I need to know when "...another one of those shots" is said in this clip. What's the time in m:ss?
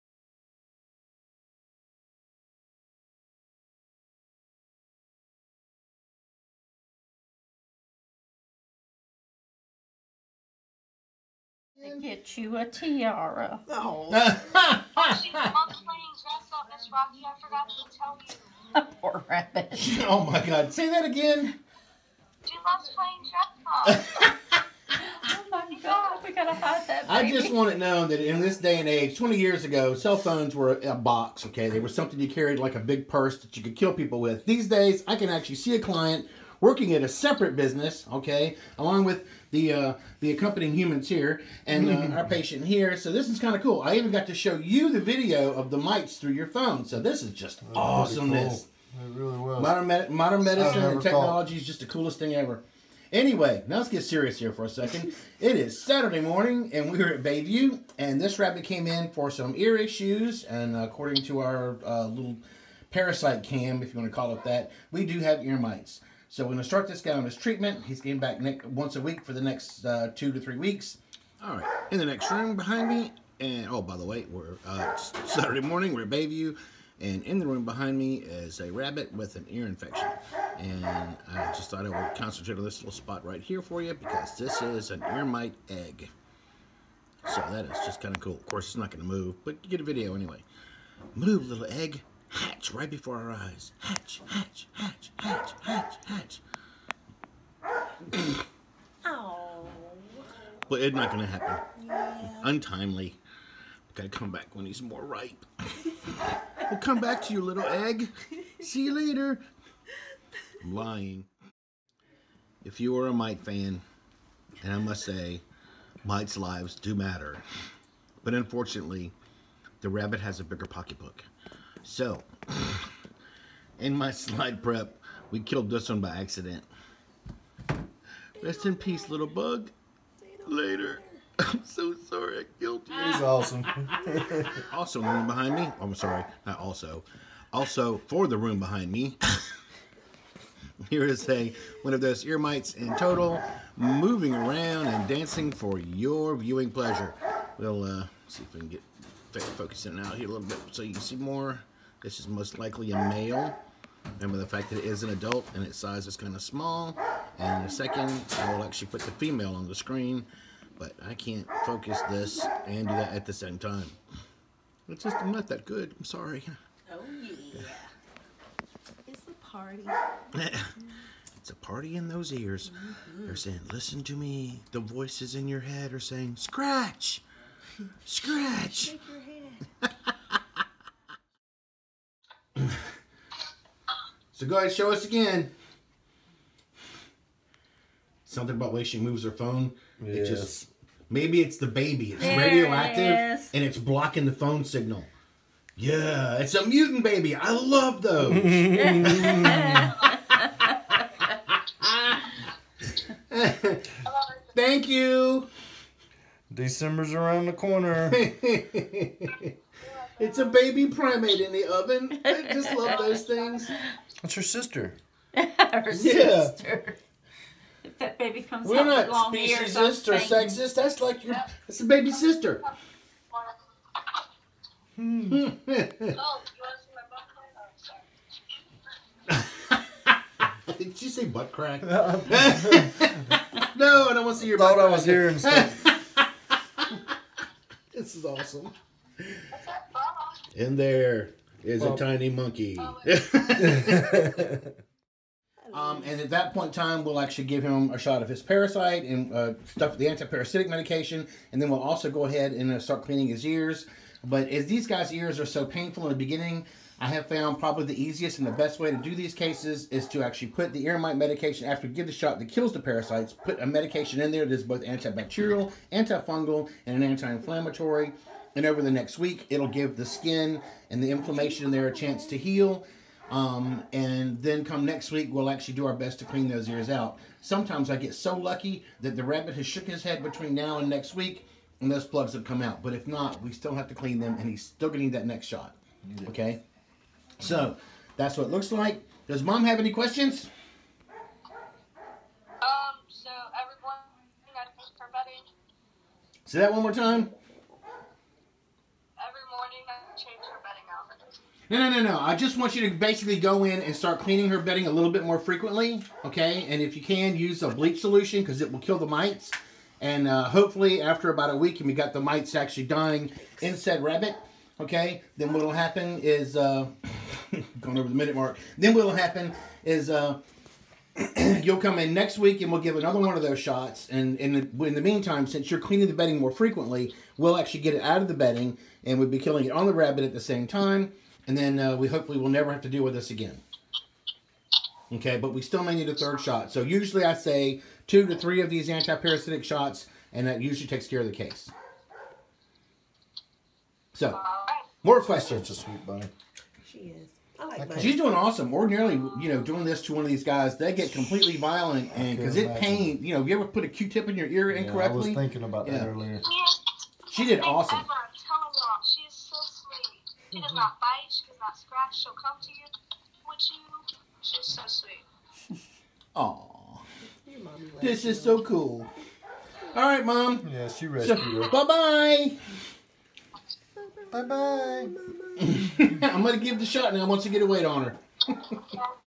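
5:22.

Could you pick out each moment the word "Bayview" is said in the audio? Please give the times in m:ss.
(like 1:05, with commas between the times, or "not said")
0:57, 1:16.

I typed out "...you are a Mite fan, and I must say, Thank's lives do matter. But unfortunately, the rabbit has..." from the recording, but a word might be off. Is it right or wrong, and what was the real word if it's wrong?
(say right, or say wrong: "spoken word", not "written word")
wrong: "Mite", not "Thank".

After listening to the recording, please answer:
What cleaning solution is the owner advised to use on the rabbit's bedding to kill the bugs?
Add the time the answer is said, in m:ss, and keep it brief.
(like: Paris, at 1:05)
bleach solution, at 5:07.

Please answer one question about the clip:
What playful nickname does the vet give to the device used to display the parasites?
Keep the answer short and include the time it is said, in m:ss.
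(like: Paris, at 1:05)
parasite cam, at 1:02.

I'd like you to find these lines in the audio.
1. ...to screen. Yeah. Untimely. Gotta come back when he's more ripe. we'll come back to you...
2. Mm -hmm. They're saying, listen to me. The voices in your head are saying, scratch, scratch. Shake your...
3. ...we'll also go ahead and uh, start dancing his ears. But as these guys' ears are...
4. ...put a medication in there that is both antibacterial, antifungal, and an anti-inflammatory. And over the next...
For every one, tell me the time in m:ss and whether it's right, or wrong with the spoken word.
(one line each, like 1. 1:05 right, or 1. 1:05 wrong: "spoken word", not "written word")
1. 1:41 wrong: "happen", not "screen"
2. 2:52 right
3. 4:11 wrong: "cleaning", not "dancing"
4. 4:23 right.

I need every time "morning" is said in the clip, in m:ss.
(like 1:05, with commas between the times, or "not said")
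0:56, 1:15.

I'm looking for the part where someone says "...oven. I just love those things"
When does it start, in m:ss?
3:31.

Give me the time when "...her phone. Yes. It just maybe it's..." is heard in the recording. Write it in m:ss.
3:09.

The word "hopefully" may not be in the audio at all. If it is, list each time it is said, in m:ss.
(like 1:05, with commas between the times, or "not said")
5:10, 5:32.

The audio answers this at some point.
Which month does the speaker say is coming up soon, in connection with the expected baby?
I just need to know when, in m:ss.
3:26.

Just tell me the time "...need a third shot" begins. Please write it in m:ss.
5:35.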